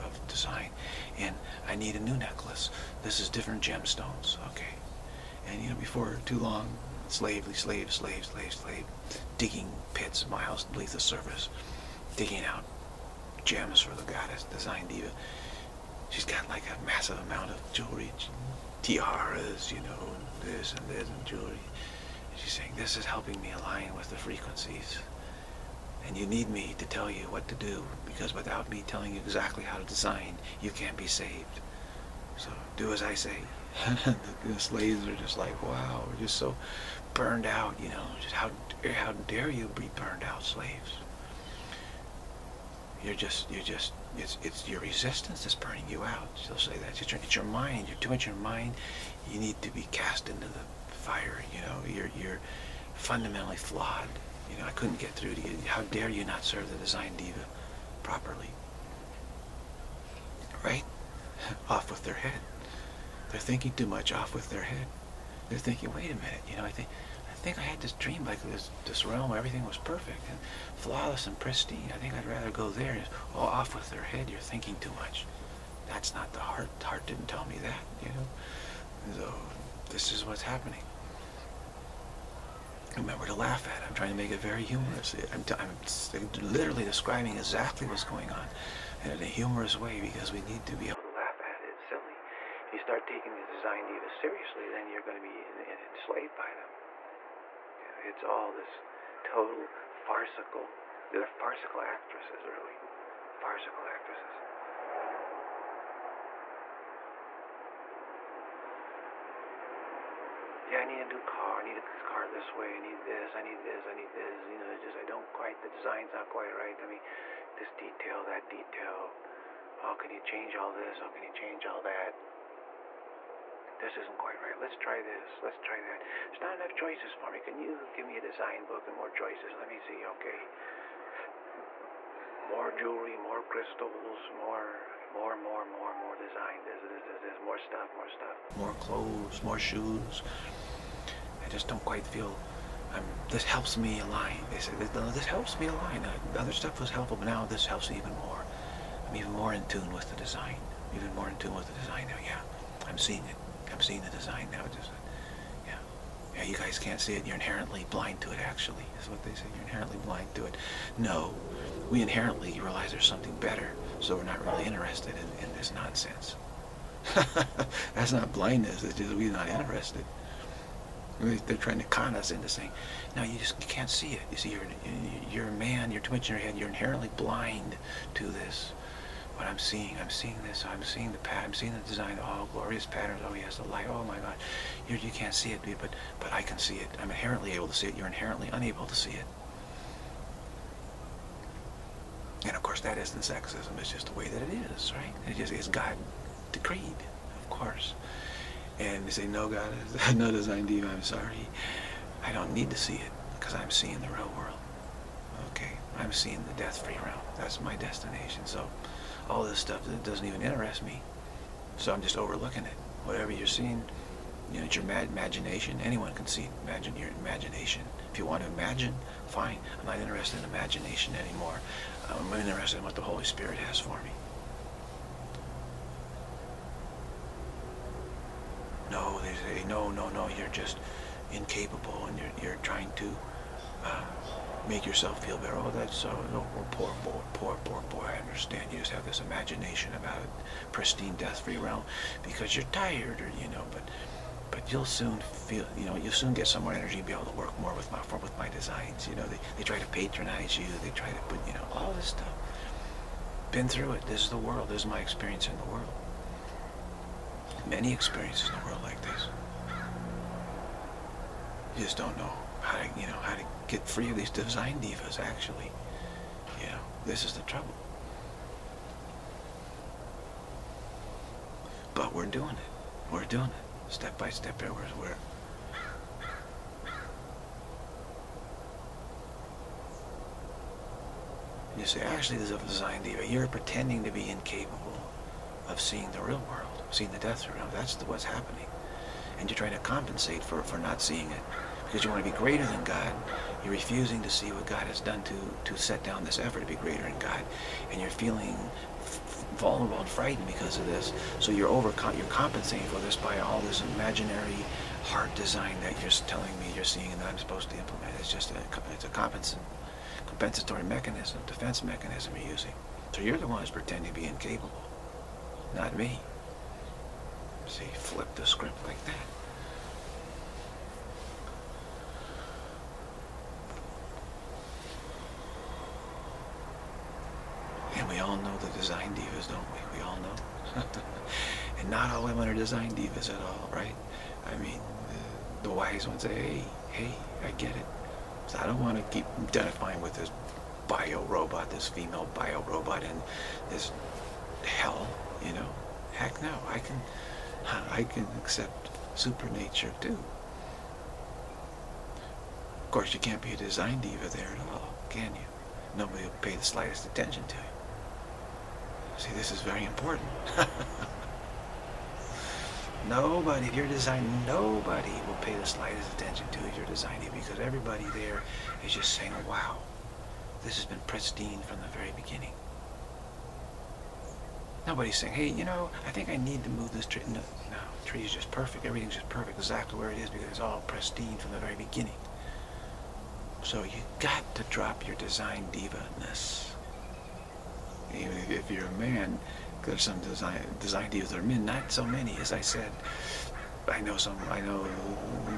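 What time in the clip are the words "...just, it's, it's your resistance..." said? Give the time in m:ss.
0:43.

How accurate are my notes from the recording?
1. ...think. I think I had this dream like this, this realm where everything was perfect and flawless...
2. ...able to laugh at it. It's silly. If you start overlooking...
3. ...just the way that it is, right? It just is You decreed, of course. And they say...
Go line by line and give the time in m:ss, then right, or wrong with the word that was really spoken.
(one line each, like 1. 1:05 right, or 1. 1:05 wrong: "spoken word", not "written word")
1. 1:06 right
2. 1:30 wrong: "taking", not "overlooking"
3. 3:13 wrong: "God", not "You".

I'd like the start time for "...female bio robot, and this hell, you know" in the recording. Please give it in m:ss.
5:41.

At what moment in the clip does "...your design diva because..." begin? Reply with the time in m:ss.
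6:06.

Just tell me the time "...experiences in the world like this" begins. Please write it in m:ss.
4:17.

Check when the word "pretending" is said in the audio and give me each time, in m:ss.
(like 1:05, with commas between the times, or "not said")
4:43, 5:13.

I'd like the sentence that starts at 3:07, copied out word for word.
I'm inherently able to see it, you're inherently unable to see it.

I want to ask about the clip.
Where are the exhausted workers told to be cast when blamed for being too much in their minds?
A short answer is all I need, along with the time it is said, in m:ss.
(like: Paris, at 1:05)
The fire, at 0:50.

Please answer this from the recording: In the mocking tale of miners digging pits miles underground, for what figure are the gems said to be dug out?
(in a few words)
The goddess.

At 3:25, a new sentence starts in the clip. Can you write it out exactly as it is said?
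Okay, I'm seeing the death-free realm.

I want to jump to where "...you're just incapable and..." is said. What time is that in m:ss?
3:50.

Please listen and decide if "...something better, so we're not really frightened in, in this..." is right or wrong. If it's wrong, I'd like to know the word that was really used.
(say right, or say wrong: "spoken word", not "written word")
wrong: "interested", not "frightened".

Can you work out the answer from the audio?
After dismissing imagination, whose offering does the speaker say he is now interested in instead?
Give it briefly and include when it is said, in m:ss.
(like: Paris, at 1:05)
The Holy Spirit, at 3:43.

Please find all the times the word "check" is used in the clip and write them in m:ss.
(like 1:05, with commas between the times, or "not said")
not said.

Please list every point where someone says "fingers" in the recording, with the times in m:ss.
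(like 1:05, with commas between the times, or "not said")
not said.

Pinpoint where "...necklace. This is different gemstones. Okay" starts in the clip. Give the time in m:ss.
0:02.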